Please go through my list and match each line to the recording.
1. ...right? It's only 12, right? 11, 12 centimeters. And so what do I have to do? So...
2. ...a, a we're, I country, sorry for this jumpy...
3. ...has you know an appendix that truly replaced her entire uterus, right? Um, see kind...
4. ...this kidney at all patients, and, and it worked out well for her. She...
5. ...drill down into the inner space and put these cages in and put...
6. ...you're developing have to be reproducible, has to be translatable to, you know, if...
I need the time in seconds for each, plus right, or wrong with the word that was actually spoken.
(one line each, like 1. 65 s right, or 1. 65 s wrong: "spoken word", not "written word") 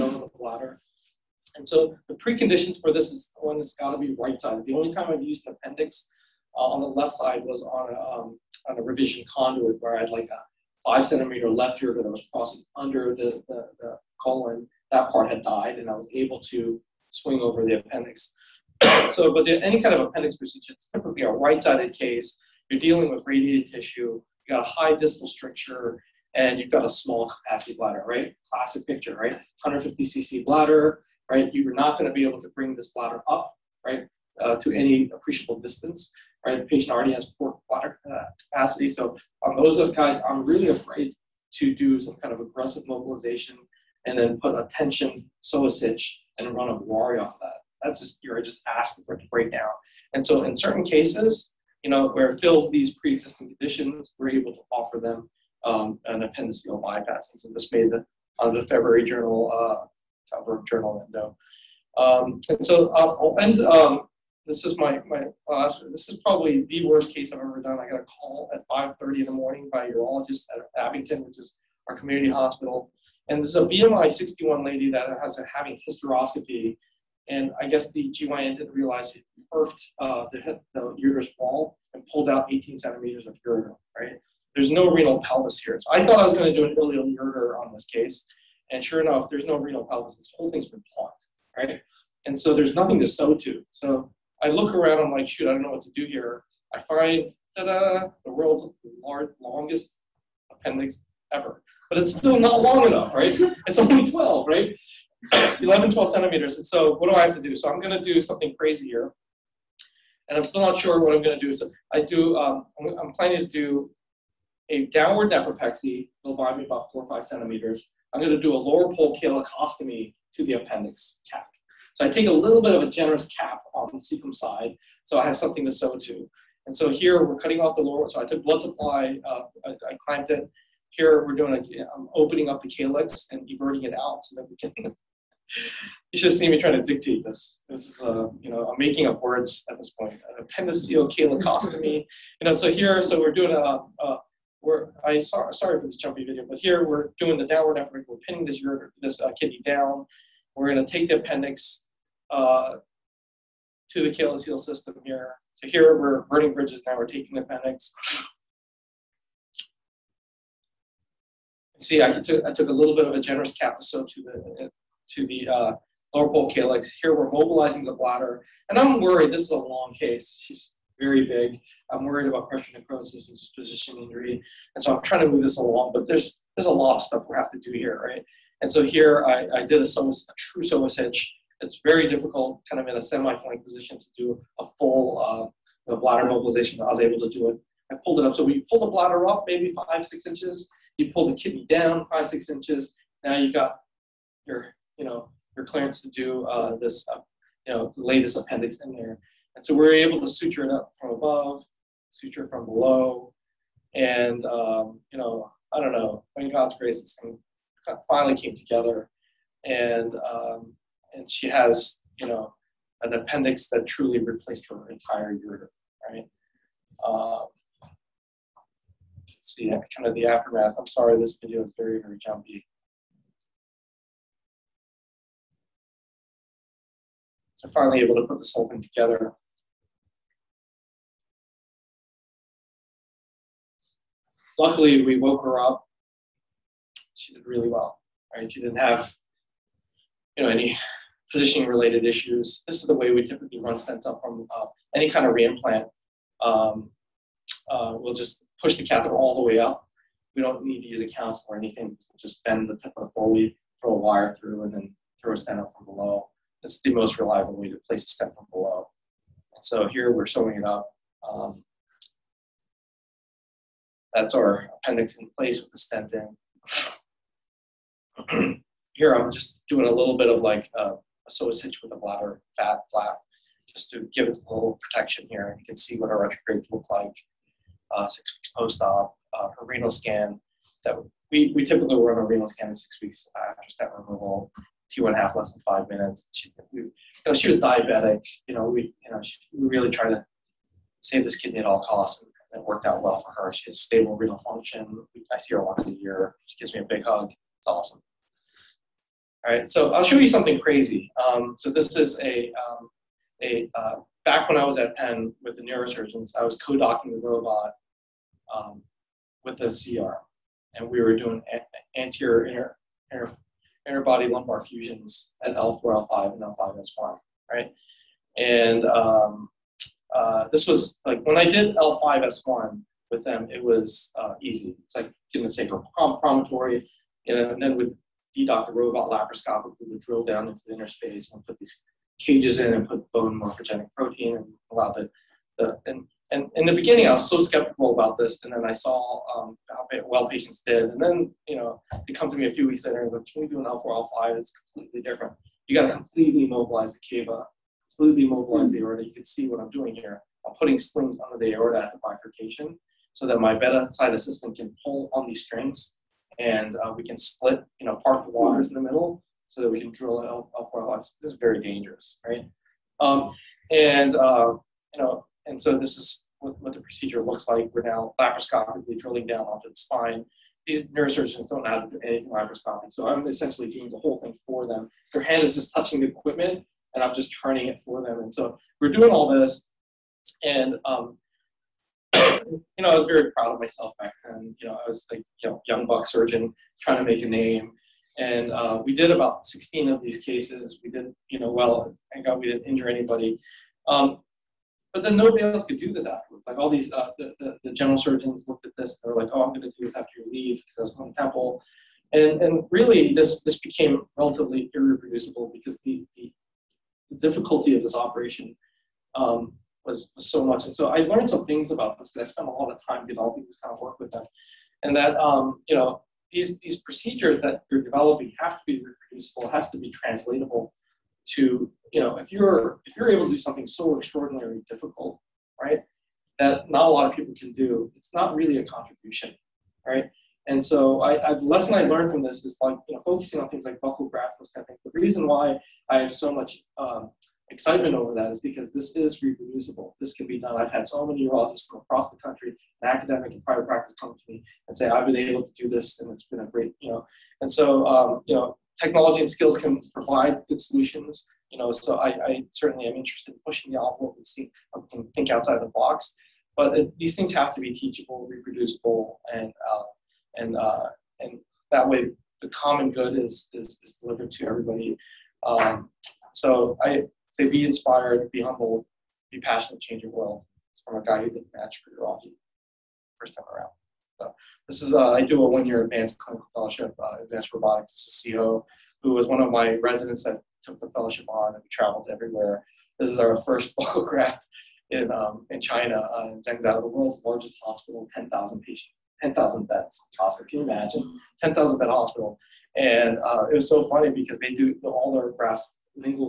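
1. 103 s right
2. 143 s wrong: "sorry", not "country"
3. 211 s right
4. 291 s wrong: "costs", not "patients"
5. 330 s right
6. 417 s right.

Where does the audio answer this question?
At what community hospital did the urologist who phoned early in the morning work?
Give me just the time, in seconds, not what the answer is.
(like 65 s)
70 s.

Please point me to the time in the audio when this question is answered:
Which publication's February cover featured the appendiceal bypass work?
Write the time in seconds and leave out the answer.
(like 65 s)
60 s.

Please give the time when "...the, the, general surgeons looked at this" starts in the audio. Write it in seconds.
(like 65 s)
397 s.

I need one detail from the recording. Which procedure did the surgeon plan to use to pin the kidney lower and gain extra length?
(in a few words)
downward nephropexy.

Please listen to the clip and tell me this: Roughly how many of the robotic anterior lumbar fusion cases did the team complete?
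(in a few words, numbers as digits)
16.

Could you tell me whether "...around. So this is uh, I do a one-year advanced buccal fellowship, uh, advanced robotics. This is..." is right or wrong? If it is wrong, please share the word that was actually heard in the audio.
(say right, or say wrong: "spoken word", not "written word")
wrong: "clinical", not "buccal".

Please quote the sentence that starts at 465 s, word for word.
Um, so I say be inspired, be humble, be passionate, change your world.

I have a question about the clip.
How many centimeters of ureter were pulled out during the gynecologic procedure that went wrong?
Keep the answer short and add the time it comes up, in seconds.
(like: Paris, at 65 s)
18, at 82 s.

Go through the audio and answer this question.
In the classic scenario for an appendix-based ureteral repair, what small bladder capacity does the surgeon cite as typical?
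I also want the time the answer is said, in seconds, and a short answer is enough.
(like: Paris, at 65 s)
150 cc, at 29 s.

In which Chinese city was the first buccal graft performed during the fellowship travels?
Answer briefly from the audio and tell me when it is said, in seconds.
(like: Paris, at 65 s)
Zhengzhou, at 486 s.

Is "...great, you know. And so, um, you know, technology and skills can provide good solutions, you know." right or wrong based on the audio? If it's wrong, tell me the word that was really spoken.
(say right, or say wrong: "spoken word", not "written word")
right.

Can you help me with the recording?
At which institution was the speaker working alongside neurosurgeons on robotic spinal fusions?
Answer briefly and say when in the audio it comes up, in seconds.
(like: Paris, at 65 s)
Penn, at 304 s.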